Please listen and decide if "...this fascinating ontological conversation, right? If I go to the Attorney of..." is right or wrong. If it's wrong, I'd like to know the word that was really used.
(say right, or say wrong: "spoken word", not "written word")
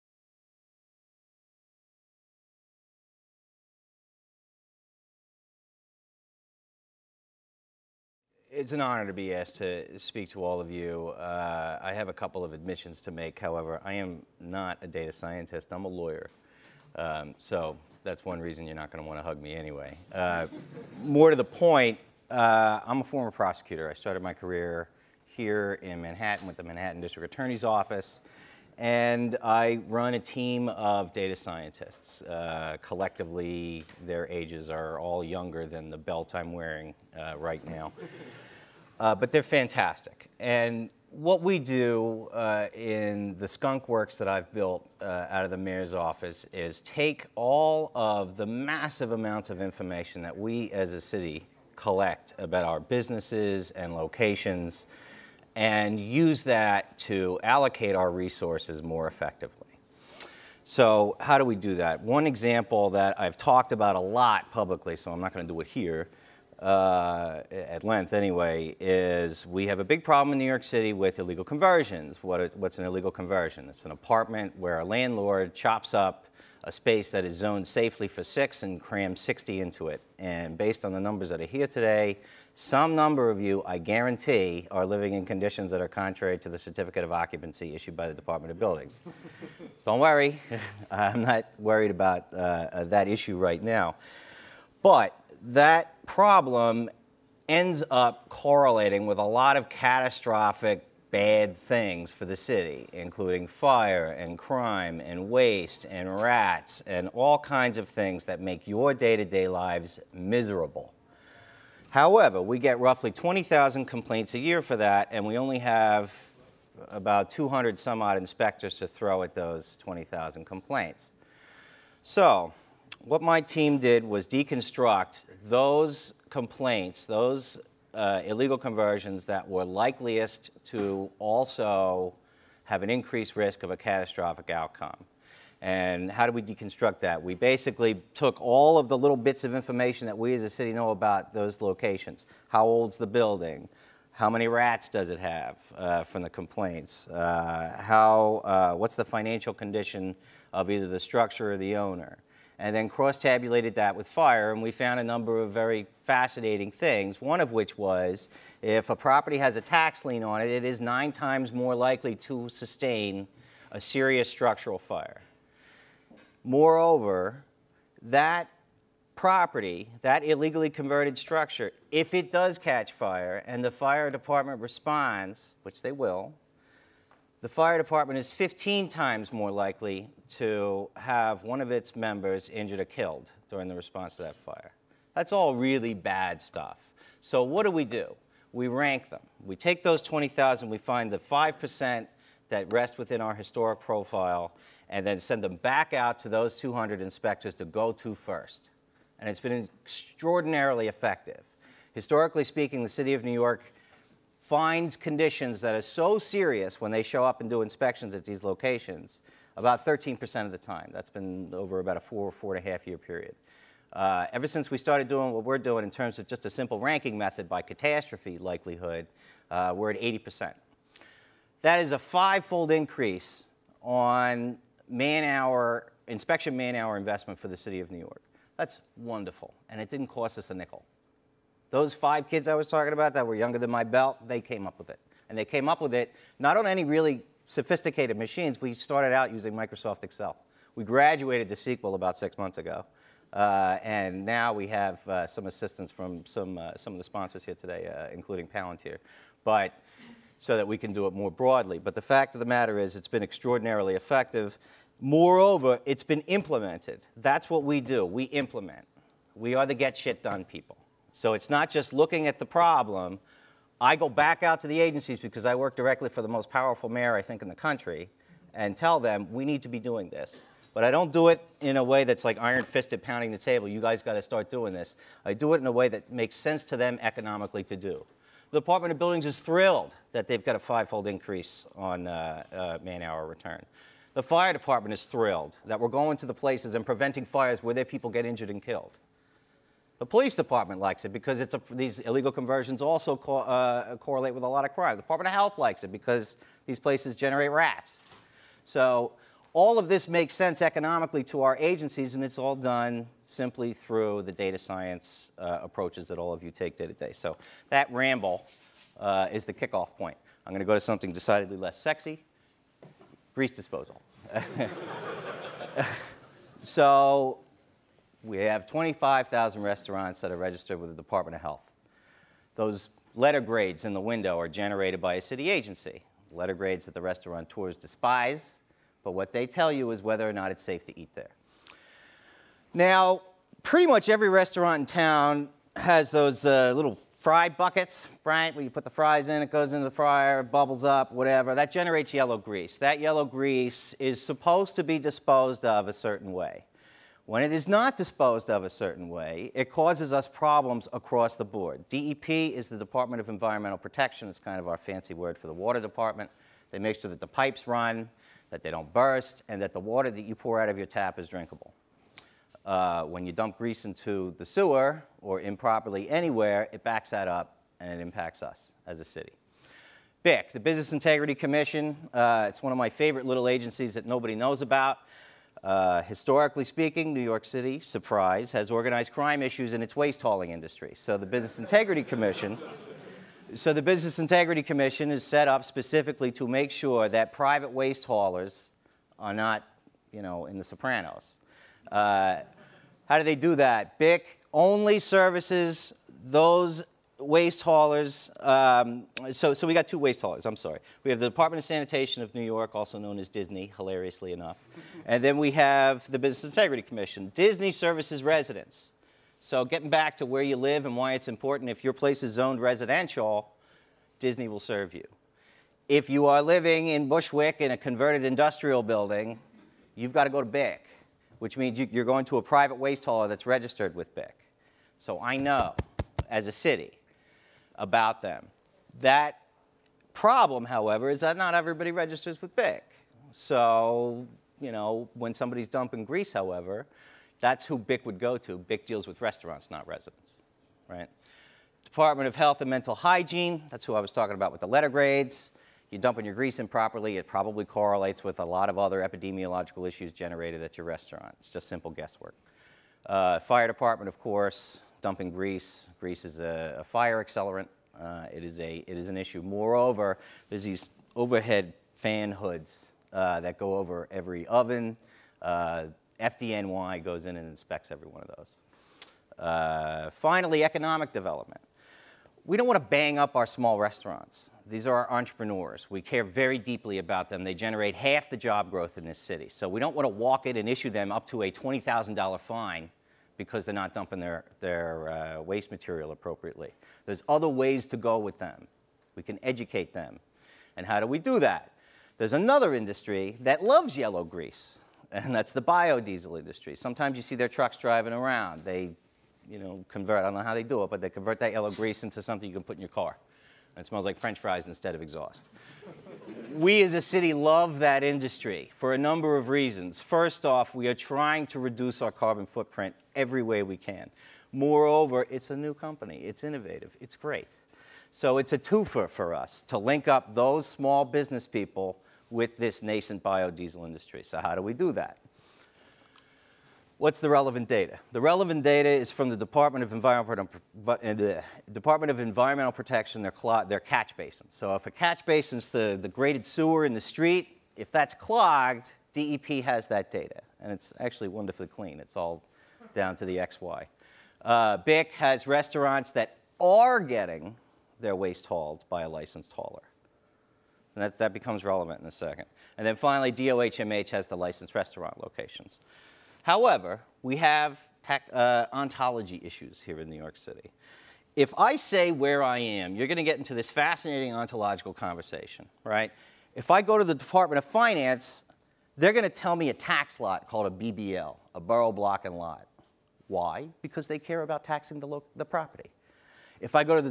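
wrong: "Department", not "Attorney".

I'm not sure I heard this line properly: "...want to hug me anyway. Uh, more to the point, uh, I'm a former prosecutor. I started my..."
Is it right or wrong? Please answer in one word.
right.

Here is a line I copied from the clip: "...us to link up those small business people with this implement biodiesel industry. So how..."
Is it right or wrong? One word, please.
wrong.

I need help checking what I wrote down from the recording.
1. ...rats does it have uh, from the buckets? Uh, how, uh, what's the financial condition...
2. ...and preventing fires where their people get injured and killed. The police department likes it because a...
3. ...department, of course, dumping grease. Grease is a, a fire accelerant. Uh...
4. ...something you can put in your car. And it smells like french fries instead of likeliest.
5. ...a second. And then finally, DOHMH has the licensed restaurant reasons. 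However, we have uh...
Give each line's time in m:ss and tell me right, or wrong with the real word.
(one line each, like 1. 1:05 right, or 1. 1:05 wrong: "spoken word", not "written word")
1. 2:24 wrong: "complaints", not "buckets"
2. 4:46 right
3. 7:33 right
4. 8:22 wrong: "exhaust", not "likeliest"
5. 9:12 wrong: "locations", not "reasons".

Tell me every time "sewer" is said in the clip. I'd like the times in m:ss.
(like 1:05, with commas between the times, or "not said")
6:04, 8:56.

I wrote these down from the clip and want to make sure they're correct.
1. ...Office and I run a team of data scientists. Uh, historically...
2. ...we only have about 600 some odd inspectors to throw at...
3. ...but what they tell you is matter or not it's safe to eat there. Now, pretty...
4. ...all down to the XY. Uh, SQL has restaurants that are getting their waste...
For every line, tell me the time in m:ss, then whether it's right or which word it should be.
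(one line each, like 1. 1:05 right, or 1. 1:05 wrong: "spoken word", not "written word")
1. 0:27 wrong: "collectively", not "historically"
2. 1:55 wrong: "200", not "600"
3. 5:29 wrong: "whether", not "matter"
4. 9:02 wrong: "BIC", not "SQL".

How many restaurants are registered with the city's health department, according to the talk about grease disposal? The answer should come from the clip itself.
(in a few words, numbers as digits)
25,000.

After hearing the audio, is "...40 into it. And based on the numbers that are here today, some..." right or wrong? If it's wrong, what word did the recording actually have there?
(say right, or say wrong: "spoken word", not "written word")
wrong: "60", not "40".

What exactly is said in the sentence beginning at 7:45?
Uh, FDNY goes in and inspects every one of those.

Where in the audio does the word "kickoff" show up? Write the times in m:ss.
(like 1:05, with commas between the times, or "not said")
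5:09.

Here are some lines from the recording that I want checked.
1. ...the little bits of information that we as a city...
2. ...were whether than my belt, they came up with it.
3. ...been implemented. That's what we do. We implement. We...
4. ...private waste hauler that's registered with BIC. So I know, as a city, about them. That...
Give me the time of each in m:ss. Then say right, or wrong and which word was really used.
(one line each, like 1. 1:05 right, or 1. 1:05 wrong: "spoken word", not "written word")
1. 2:18 right
2. 3:53 wrong: "younger", not "whether"
3. 4:16 right
4. 7:02 right.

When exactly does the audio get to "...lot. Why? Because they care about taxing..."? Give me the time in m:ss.
9:32.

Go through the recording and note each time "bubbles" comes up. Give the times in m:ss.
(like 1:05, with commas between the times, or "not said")
5:40.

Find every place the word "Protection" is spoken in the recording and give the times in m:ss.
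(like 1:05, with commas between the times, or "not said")
5:53, 8:52.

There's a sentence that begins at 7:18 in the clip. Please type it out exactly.
BIC deals with restaurants, not residents, right?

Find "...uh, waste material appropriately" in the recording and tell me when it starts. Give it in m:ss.
8:05.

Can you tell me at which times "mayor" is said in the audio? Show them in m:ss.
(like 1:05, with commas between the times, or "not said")
0:45, 4:26.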